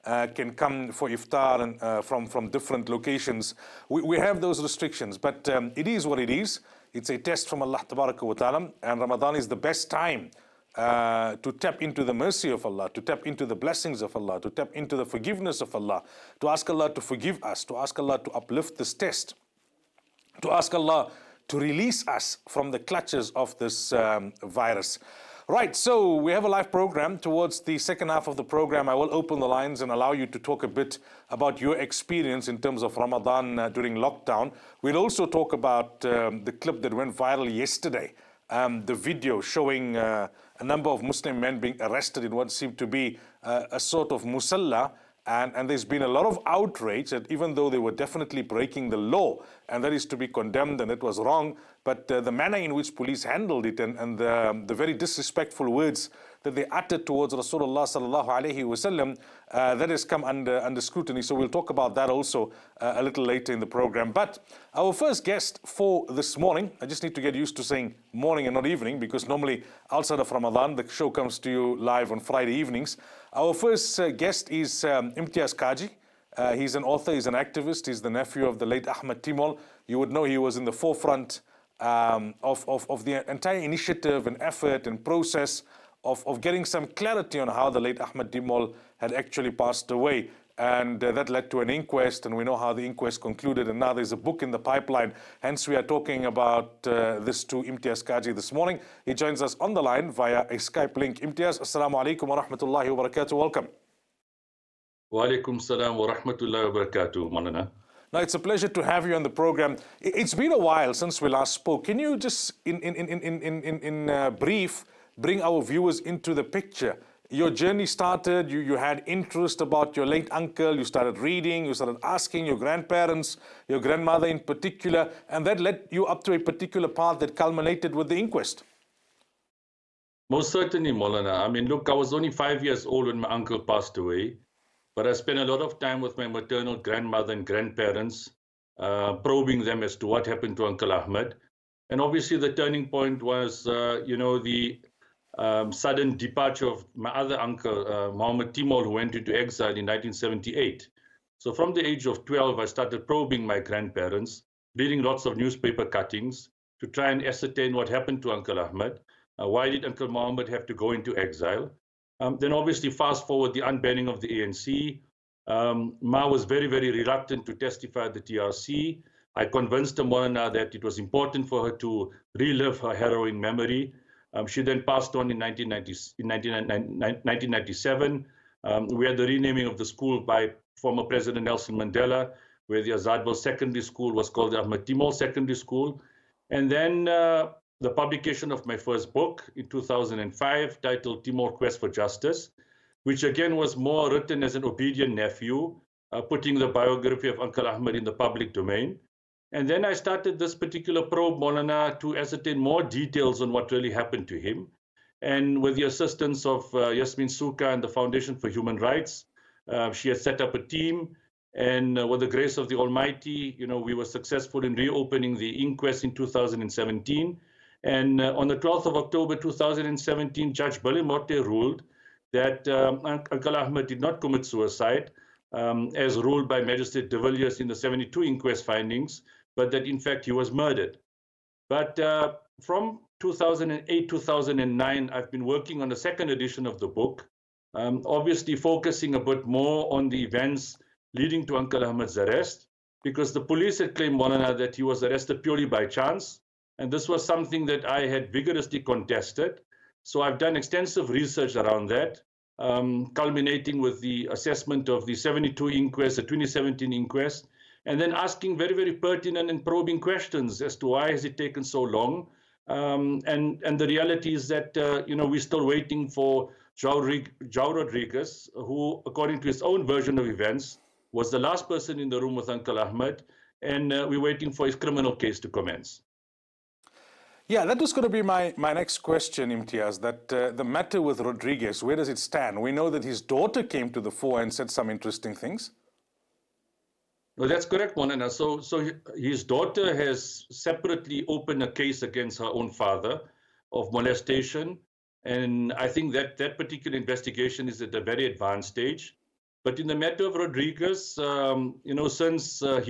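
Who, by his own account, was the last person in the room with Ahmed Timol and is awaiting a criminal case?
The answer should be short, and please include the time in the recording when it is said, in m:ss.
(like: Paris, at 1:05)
João Rodrigues, at 4:26.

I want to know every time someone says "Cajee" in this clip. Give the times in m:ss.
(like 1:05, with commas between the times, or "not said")
1:15, 1:38.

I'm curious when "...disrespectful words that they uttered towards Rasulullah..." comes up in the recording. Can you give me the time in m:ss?
0:54.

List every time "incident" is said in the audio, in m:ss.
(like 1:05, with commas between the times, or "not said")
not said.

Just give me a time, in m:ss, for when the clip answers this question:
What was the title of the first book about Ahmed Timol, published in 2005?
3:11.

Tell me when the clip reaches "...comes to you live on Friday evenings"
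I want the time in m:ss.
1:11.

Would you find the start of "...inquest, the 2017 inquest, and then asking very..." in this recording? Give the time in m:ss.
4:15.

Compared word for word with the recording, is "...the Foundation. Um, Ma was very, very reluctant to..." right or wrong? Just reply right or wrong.
wrong.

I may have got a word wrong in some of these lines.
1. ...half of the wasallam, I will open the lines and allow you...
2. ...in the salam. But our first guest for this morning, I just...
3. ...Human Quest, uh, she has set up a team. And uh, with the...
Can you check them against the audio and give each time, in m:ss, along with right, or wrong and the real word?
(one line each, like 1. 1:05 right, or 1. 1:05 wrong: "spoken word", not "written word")
1. 0:28 wrong: "program", not "wasallam"
2. 1:03 wrong: "program", not "salam"
3. 3:28 wrong: "Rights", not "Quest".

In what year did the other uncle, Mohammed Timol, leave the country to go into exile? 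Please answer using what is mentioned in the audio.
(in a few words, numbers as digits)
1978.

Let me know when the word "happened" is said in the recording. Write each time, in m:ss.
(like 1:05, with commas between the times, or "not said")
2:20, 2:37, 3:23.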